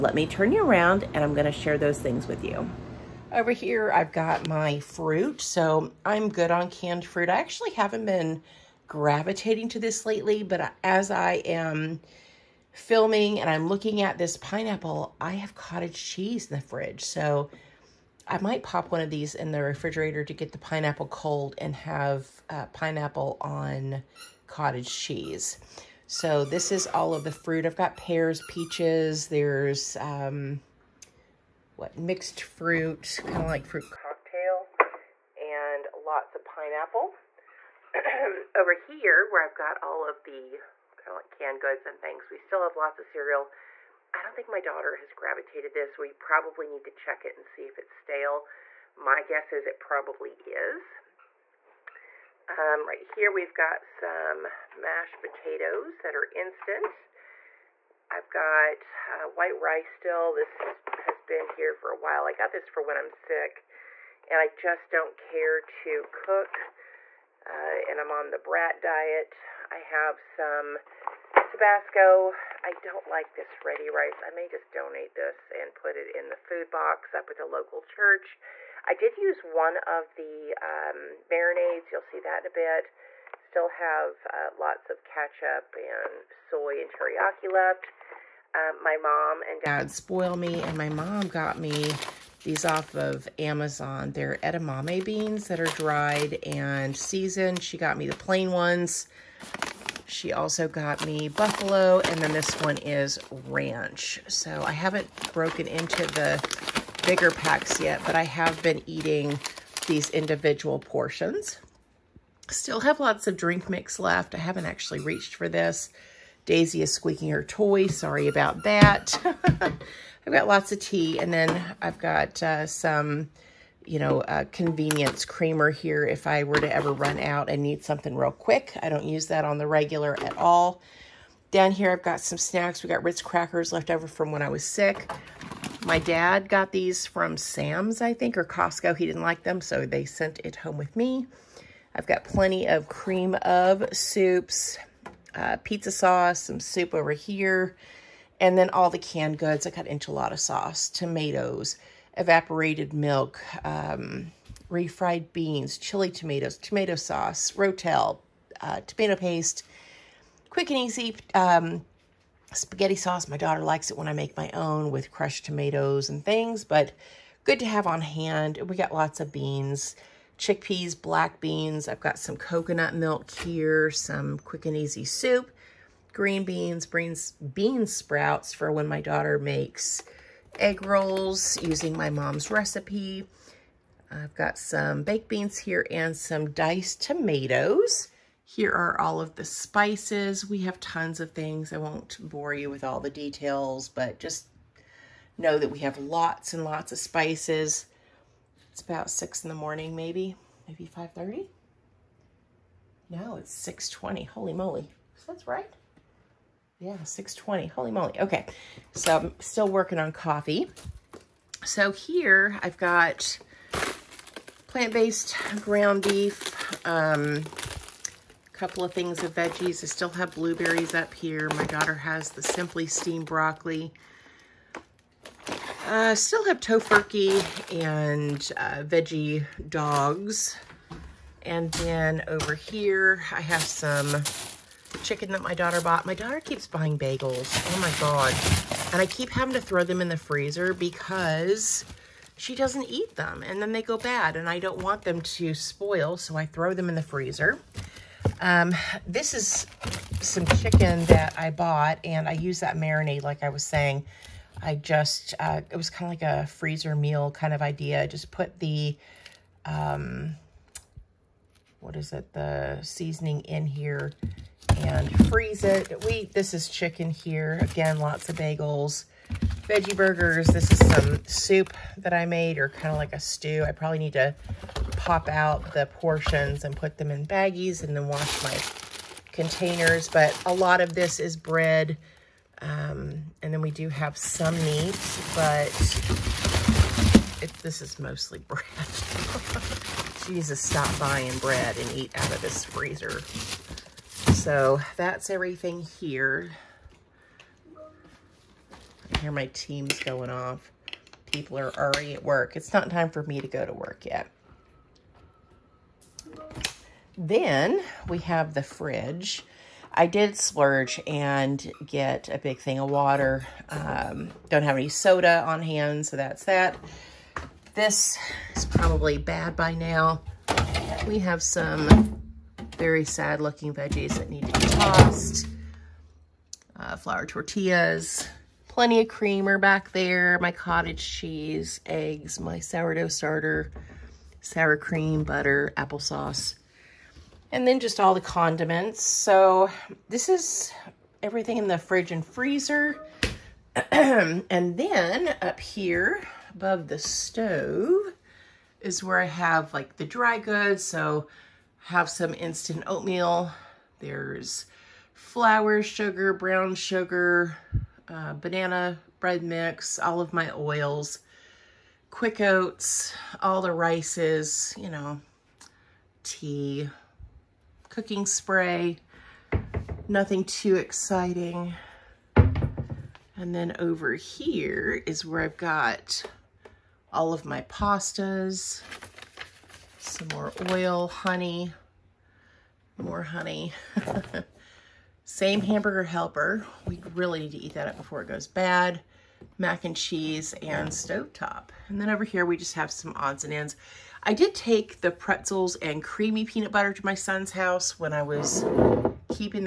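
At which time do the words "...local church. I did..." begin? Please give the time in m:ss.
1:17.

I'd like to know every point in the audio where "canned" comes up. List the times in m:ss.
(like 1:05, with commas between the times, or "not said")
0:06, 0:41, 2:28.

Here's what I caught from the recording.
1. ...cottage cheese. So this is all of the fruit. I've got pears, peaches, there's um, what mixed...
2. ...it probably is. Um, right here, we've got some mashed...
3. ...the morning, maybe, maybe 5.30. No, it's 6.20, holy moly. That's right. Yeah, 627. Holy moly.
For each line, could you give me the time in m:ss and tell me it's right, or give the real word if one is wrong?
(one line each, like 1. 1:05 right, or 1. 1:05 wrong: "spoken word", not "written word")
1. 0:24 right
2. 0:49 right
3. 3:19 wrong: "620", not "627".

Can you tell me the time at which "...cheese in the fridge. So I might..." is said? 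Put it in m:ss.
0:15.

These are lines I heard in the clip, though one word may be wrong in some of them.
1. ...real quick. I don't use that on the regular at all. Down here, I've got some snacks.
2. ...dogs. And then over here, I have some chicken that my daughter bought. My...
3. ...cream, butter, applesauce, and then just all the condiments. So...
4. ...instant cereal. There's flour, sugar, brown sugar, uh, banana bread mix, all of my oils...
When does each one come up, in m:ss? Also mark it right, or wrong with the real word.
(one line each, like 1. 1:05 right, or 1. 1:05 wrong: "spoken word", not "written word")
1. 2:08 right
2. 3:49 right
3. 5:34 right
4. 5:52 wrong: "oatmeal", not "cereal".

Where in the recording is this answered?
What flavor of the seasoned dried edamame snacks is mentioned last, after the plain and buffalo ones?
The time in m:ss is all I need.
1:43.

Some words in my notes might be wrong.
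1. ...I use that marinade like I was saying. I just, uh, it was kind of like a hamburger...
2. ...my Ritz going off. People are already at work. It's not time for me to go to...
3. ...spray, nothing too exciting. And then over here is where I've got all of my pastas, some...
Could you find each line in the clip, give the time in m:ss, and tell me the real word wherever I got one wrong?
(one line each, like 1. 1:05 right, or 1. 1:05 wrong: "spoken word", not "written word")
1. 4:12 wrong: "freezer", not "hamburger"
2. 4:59 wrong: "Teams", not "Ritz"
3. 6:08 right.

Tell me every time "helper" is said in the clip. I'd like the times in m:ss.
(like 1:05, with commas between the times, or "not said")
6:26.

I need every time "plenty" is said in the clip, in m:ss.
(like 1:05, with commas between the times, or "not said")
2:22, 5:28.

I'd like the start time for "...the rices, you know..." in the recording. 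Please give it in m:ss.
6:03.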